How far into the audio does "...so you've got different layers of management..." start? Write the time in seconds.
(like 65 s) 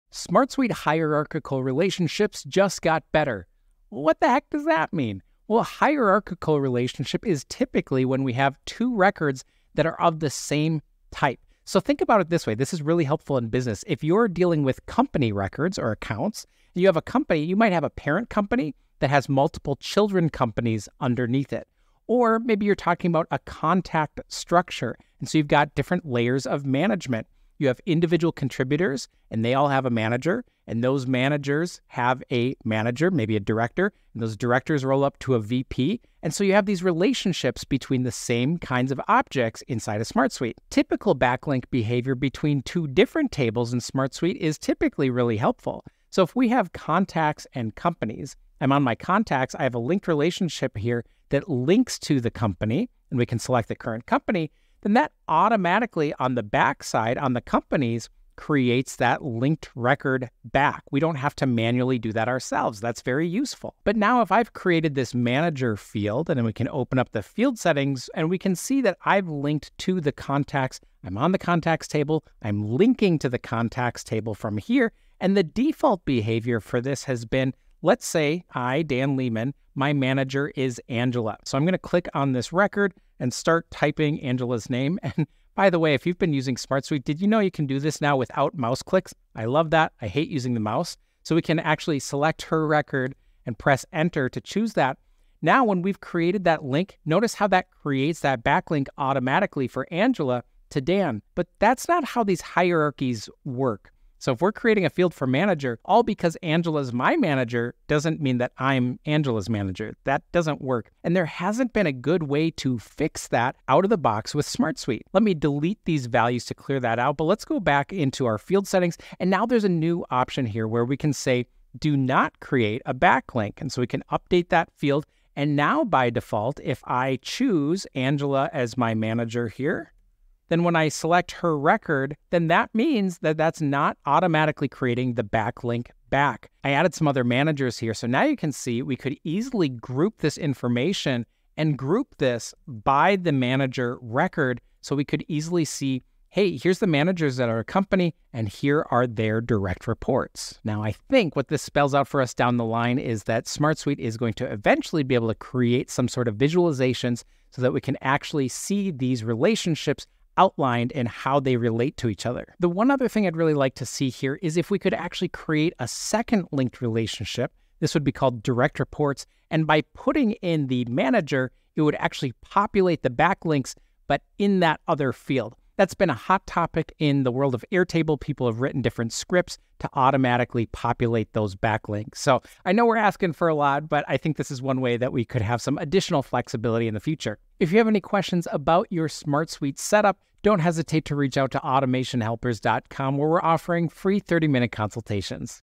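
25 s.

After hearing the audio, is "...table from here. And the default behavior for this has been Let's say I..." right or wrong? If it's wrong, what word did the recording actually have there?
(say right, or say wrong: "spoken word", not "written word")
right.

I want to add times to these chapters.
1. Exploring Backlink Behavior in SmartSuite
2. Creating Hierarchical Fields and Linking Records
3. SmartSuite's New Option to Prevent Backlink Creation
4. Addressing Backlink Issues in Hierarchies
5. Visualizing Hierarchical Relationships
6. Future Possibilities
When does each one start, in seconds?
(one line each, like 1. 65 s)
1. 40 s
2. 63 s
3. 119 s
4. 95 s
5. 136 s
6. 162 s.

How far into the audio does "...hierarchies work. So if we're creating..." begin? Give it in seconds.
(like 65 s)
102 s.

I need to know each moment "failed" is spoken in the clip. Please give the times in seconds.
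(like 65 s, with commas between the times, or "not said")
not said.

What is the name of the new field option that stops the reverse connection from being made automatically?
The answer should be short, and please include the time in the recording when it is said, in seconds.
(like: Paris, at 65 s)
do not create a backlink, at 121 s.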